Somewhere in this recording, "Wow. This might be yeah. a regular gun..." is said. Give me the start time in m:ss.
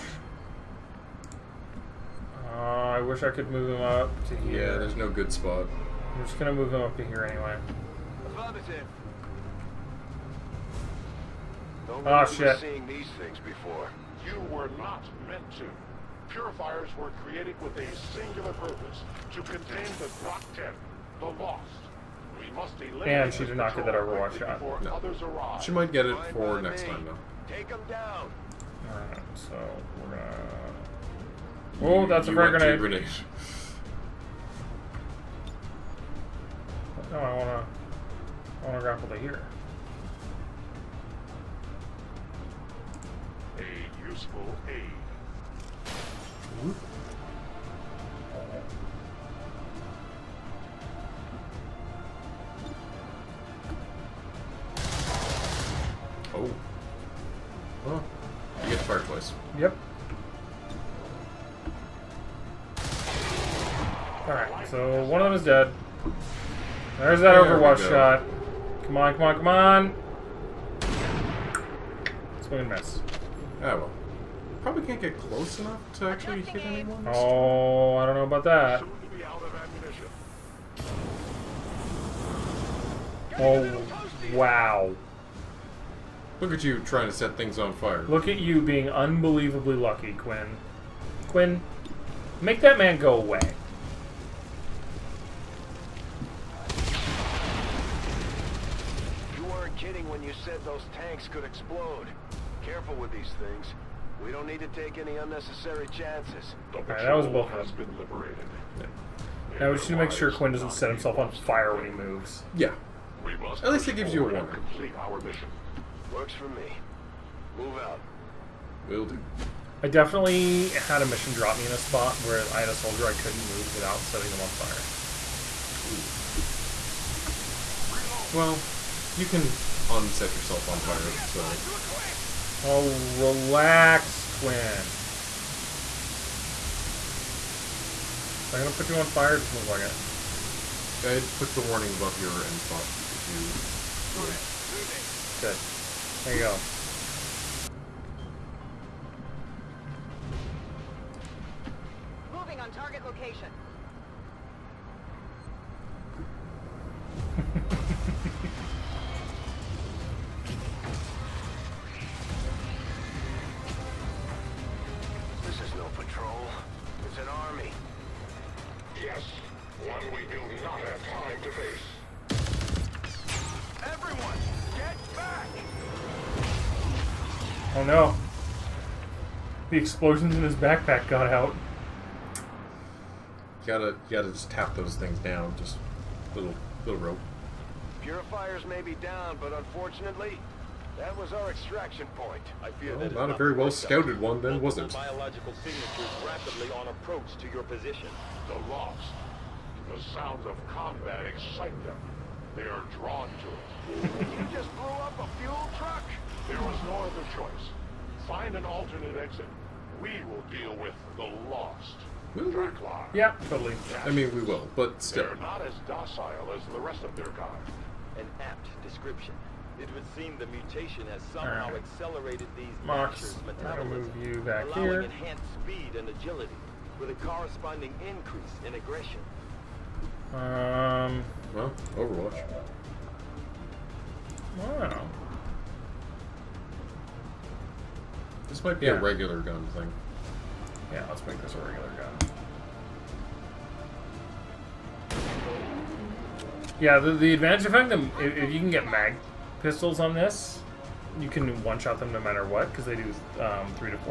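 3:54.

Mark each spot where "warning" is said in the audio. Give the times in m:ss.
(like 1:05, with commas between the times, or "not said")
1:54, 2:21.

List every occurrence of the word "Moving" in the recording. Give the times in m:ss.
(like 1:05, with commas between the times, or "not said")
2:24, 2:32.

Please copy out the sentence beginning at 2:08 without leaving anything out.
Well, you can set yourself on fire, so...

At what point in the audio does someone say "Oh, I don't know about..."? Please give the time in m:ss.
1:17.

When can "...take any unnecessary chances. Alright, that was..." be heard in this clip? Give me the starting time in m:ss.
1:44.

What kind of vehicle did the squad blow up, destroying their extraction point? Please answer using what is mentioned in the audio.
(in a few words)
Fuel truck.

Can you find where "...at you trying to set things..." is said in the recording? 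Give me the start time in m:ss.
1:26.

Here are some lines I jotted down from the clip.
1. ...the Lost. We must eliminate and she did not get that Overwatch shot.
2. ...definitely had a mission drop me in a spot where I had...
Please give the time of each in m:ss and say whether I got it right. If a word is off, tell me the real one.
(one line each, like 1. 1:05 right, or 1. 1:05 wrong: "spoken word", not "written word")
1. 0:21 right
2. 1:59 right.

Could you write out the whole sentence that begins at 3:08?
Purifiers may be down, but unfortunately, that was our extraction point.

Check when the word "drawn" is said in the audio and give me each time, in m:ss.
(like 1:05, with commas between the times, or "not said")
3:22.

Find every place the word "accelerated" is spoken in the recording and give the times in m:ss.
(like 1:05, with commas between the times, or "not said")
3:41.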